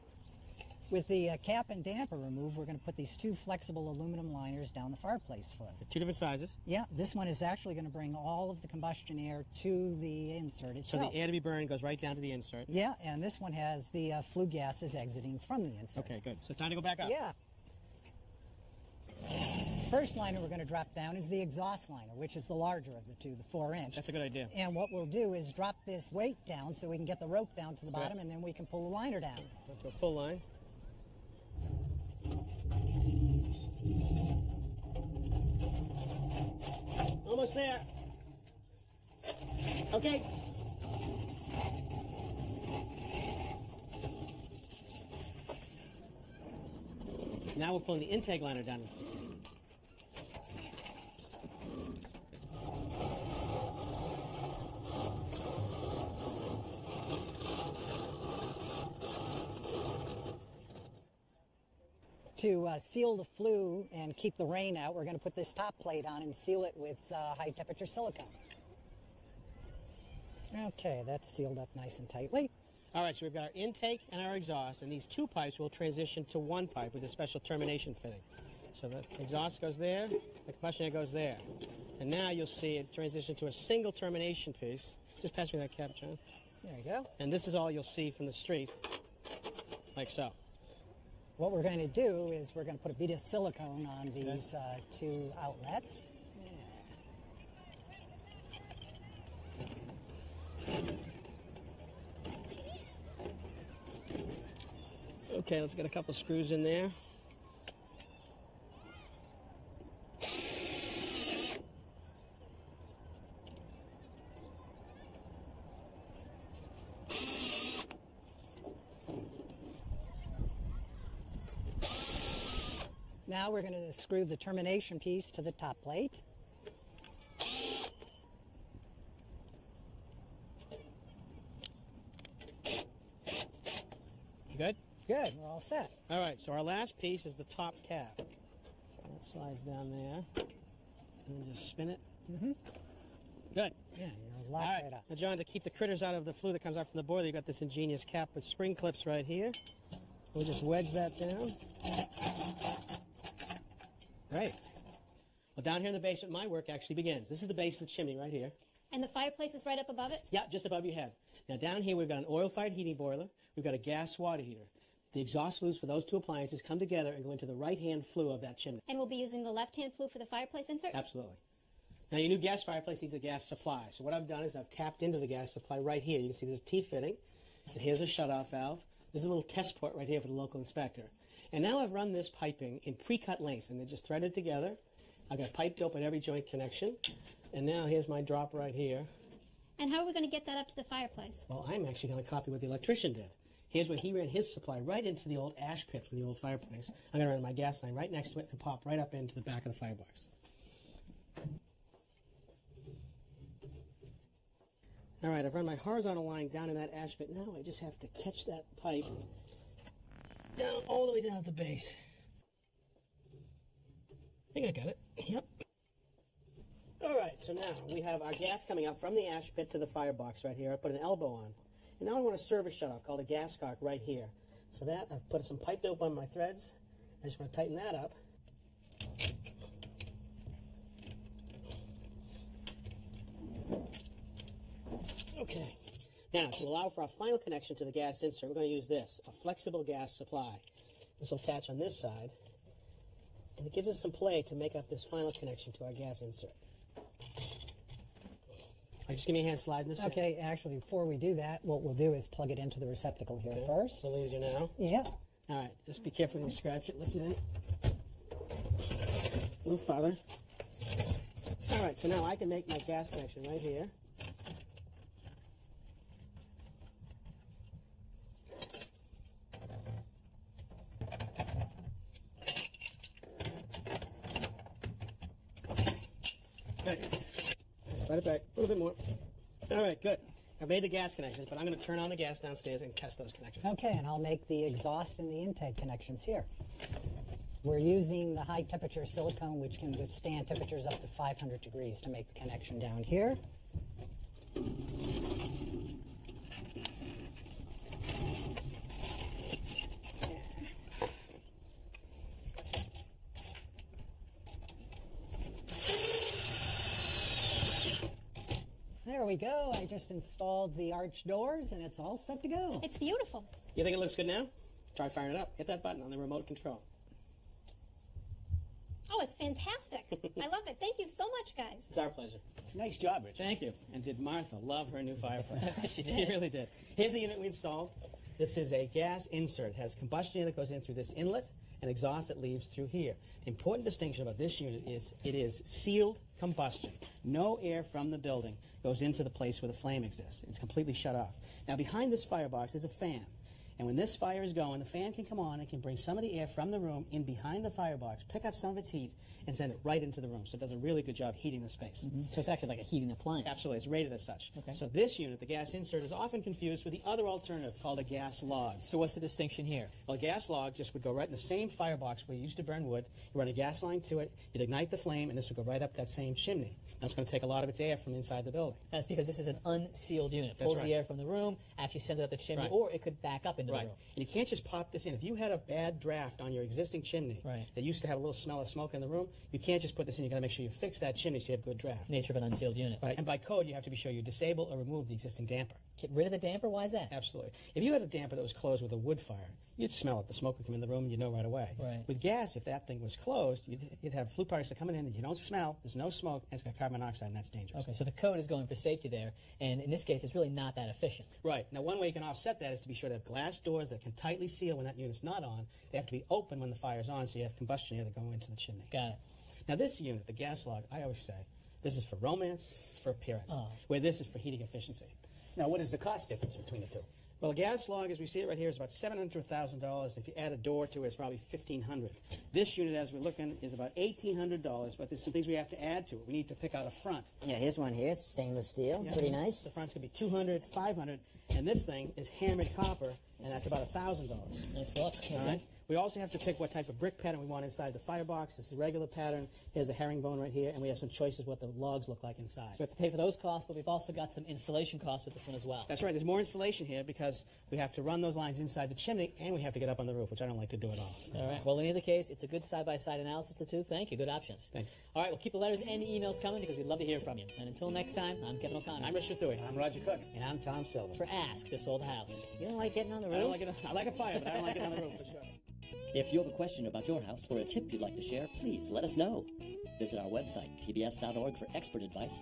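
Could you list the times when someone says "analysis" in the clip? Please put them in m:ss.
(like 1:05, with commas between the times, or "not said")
7:33.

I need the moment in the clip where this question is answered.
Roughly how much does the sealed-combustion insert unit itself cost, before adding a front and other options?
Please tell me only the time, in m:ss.
7:03.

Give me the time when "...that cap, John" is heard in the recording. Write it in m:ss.
1:25.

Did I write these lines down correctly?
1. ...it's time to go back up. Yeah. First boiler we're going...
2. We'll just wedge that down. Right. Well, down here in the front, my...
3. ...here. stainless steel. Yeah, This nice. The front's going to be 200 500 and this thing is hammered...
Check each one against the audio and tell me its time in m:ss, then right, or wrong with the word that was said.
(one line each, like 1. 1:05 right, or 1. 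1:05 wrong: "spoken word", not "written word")
1. 0:16 wrong: "liner", not "boiler"
2. 2:30 wrong: "basement", not "front"
3. 7:07 wrong: "Pretty", not "This".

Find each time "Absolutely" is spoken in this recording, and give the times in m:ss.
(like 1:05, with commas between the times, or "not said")
2:50, 5:53, 6:27.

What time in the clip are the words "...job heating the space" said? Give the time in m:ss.
5:51.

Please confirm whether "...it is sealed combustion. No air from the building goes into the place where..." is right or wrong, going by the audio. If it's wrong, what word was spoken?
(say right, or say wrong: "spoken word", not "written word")
right.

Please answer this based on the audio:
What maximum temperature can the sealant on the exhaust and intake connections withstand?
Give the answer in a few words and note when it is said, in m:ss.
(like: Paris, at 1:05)
500 degrees, at 4:51.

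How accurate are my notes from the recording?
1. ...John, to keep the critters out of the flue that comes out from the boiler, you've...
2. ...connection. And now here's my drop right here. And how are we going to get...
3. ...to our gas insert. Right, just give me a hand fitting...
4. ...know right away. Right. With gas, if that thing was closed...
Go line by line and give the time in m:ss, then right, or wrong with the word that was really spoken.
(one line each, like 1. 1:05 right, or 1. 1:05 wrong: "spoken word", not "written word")
1. 2:25 right
2. 3:06 right
3. 4:05 wrong: "sliding", not "fitting"
4. 6:31 right.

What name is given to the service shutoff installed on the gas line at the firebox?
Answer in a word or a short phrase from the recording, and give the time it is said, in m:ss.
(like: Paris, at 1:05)
Gas cock, at 3:43.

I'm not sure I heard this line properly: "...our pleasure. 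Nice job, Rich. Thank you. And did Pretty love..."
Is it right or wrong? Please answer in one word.
wrong.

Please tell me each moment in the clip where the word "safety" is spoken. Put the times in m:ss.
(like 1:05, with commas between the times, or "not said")
6:38.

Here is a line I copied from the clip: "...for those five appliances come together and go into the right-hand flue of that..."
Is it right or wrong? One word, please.
wrong.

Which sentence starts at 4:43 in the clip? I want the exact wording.
Okay, and I'll make the exhaust and the intake connections here.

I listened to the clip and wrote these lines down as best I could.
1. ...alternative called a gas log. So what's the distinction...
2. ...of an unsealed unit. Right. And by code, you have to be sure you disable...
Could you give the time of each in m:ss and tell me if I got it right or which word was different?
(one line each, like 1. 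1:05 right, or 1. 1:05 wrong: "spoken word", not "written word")
1. 5:57 right
2. 6:22 right.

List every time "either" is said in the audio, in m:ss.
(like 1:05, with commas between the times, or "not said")
7:31.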